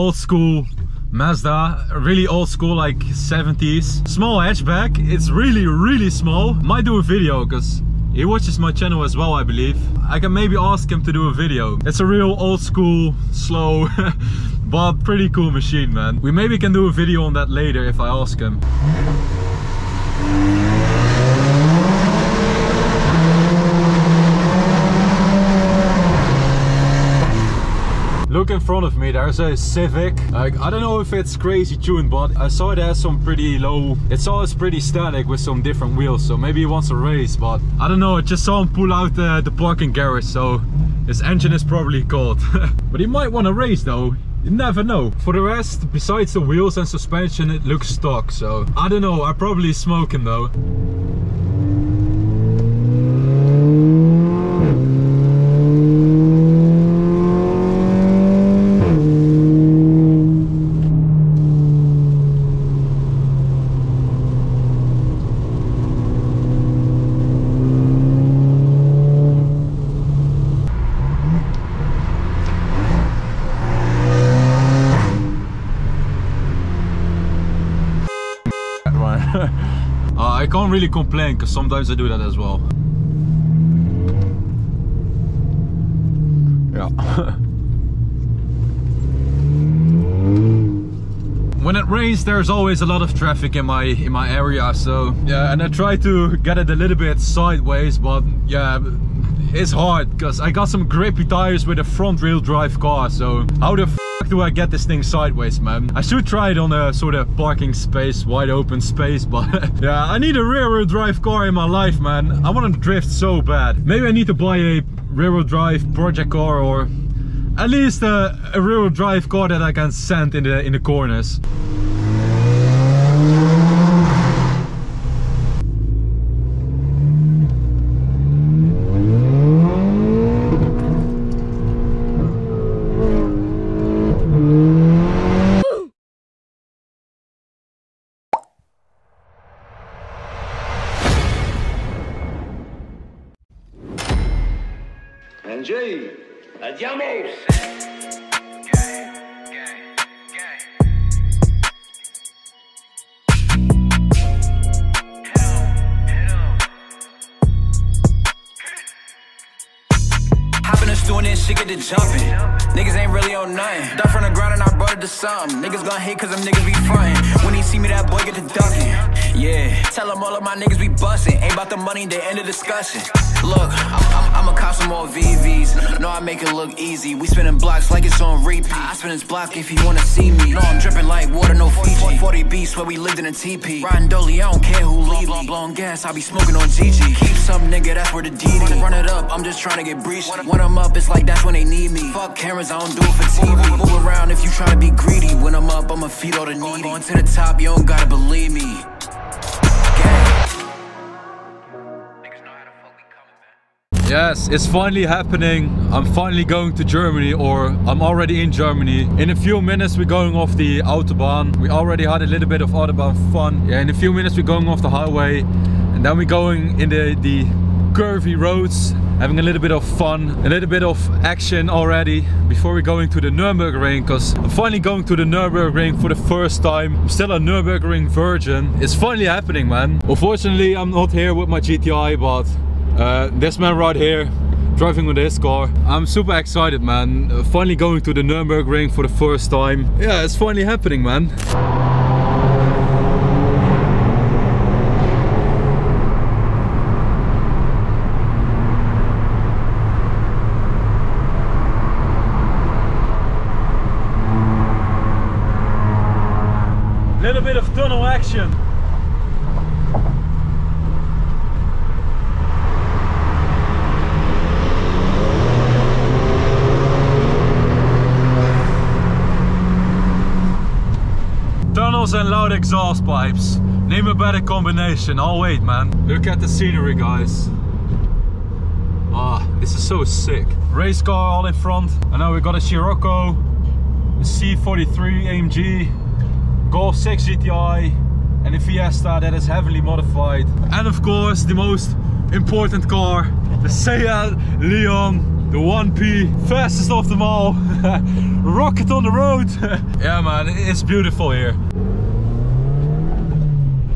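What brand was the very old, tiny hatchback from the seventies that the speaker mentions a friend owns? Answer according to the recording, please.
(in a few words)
Mazda.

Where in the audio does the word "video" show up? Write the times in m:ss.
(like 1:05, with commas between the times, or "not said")
0:07, 0:11, 0:16.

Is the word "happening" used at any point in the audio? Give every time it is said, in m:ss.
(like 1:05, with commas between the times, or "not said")
3:25, 3:49, 4:00.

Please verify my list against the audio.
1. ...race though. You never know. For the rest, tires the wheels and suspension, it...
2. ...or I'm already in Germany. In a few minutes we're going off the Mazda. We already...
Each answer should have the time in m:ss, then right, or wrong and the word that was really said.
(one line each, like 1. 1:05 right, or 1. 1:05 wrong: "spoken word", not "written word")
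1. 0:43 wrong: "besides", not "tires"
2. 3:27 wrong: "Autobahn", not "Mazda".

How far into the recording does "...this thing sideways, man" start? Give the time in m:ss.
1:44.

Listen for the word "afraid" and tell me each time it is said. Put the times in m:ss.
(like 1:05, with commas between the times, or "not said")
not said.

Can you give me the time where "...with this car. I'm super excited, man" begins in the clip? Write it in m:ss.
3:55.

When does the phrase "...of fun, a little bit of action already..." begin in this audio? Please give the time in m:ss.
3:39.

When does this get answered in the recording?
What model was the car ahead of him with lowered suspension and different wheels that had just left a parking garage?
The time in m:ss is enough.
0:29.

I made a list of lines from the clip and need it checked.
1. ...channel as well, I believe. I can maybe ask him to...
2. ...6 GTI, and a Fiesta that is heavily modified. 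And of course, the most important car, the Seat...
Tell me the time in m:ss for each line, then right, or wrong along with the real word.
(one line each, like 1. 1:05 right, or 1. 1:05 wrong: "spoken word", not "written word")
1. 0:08 right
2. 4:46 right.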